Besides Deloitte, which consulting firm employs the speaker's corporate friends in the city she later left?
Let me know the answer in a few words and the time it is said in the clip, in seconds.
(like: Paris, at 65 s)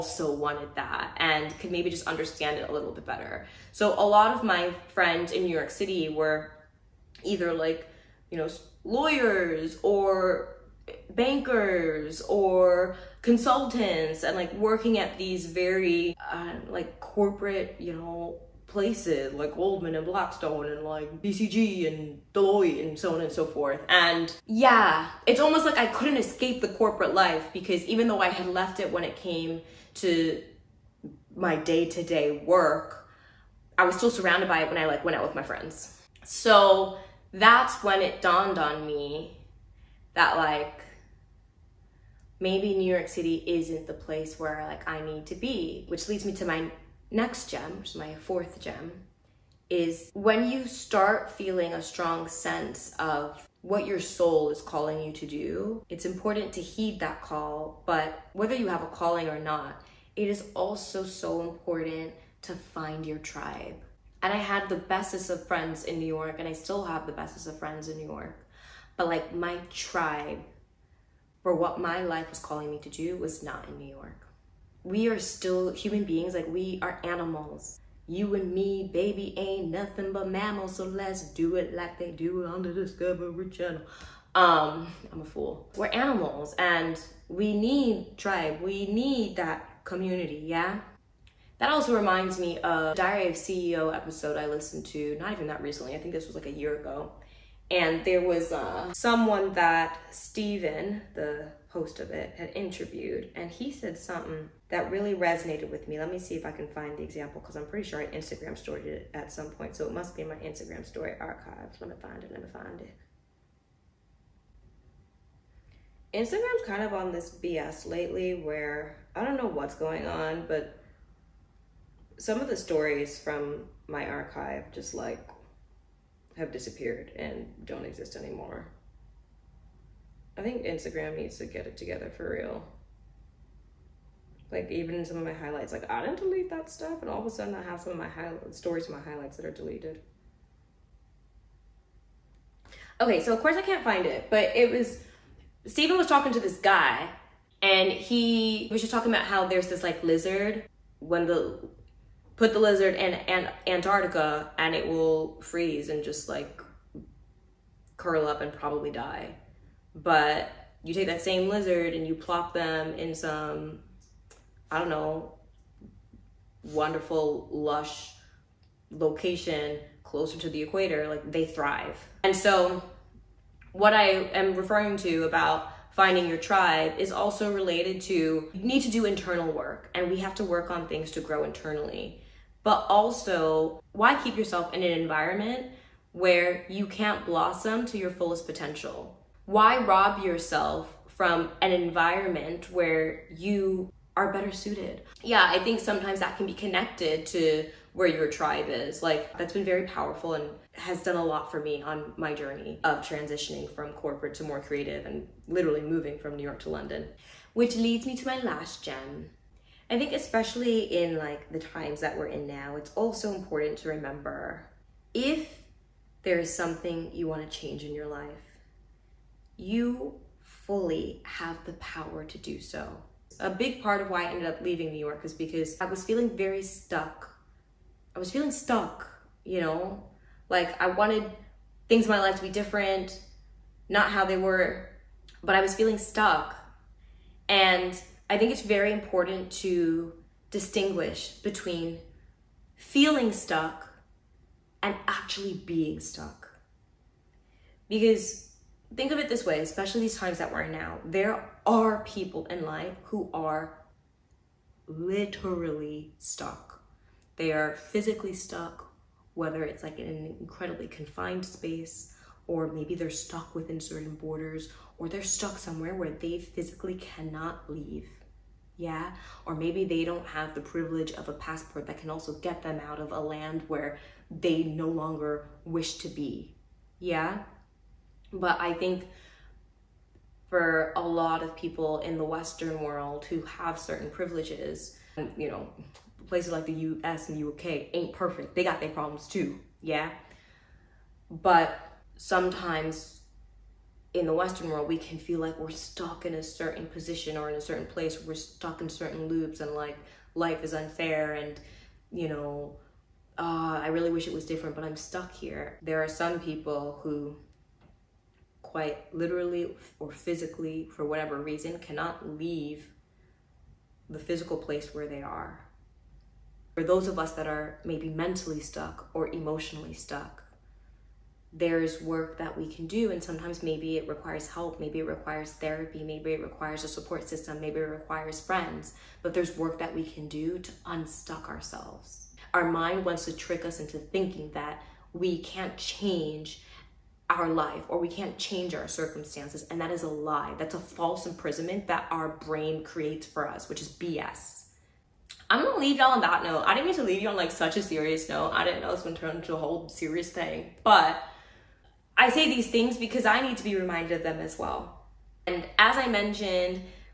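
BCG, at 21 s.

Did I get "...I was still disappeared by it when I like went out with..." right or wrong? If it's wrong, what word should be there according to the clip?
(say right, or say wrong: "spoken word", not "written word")
wrong: "surrounded", not "disappeared".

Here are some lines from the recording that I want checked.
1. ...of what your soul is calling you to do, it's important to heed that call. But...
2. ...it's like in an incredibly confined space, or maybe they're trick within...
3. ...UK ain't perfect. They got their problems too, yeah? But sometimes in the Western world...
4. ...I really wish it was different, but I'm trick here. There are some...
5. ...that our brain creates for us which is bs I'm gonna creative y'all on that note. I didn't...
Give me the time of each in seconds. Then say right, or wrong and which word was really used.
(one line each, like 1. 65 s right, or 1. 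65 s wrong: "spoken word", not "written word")
1. 52 s right
2. 259 s wrong: "stuck", not "trick"
3. 287 s right
4. 303 s wrong: "stuck", not "trick"
5. 341 s wrong: "leave", not "creative".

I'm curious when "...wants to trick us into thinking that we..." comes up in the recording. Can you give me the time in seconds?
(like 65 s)
333 s.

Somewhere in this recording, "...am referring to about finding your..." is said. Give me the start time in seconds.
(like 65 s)
174 s.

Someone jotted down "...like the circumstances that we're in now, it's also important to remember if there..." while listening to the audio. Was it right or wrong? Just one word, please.
wrong.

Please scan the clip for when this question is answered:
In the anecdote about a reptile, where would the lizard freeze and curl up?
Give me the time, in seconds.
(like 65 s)
153 s.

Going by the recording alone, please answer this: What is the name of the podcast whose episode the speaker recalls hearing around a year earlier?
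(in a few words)
Diary of CEO.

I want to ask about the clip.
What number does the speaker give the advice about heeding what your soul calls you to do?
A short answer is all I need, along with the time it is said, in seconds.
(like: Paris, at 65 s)
fourth, at 48 s.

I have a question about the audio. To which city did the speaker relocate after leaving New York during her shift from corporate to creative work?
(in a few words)
London.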